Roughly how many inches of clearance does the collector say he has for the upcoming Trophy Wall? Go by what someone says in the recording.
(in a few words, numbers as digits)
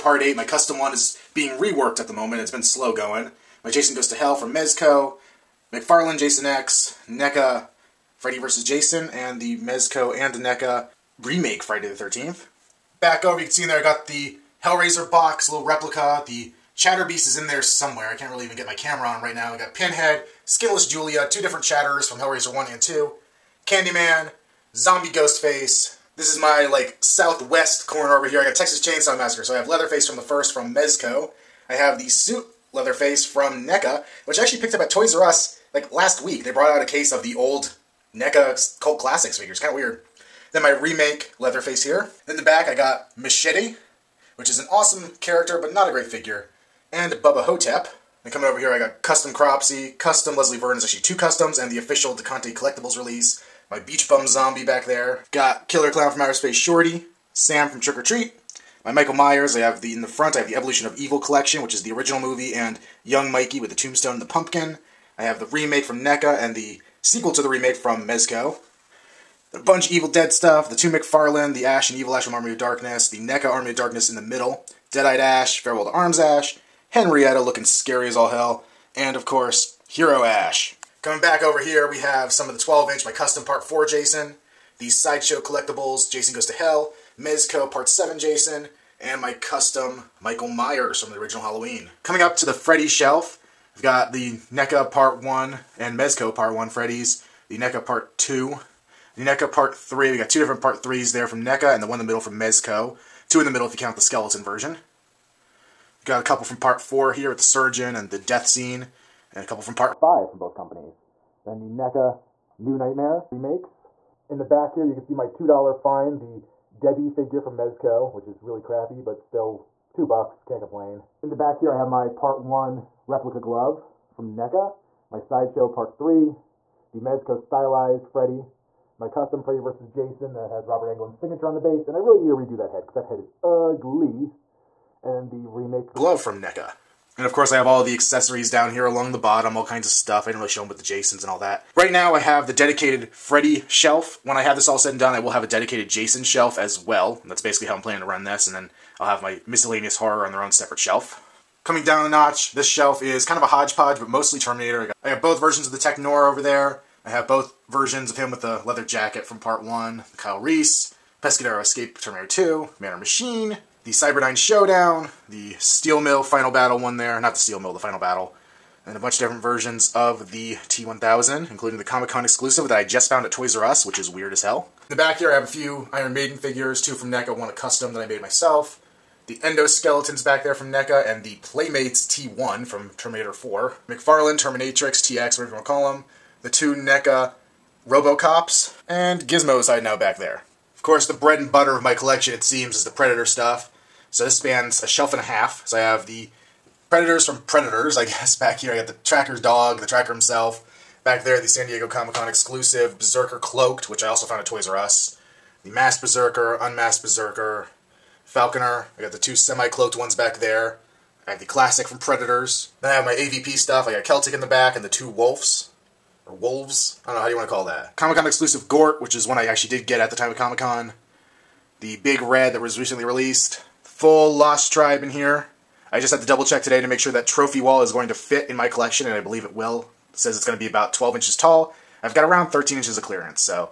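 13.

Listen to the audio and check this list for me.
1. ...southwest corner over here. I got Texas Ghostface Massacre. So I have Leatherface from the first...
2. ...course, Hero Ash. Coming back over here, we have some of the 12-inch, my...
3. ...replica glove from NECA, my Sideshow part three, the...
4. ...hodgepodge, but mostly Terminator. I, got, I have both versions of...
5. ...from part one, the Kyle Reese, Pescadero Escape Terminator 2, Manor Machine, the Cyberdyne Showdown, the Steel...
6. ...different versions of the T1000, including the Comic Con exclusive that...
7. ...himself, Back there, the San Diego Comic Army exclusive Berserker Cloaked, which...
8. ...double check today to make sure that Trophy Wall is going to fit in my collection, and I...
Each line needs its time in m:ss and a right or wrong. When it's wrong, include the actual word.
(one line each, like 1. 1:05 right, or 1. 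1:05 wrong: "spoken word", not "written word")
1. 0:27 wrong: "Chainsaw", not "Ghostface"
2. 1:19 right
3. 2:03 right
4. 2:33 right
5. 2:39 right
6. 2:49 right
7. 3:20 wrong: "Con", not "Army"
8. 3:46 right.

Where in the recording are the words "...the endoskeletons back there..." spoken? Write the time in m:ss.
2:59.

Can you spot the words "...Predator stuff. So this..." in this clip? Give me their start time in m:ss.
3:12.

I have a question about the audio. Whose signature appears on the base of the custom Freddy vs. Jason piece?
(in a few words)
Robert Englund.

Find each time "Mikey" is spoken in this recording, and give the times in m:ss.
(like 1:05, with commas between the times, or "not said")
1:03.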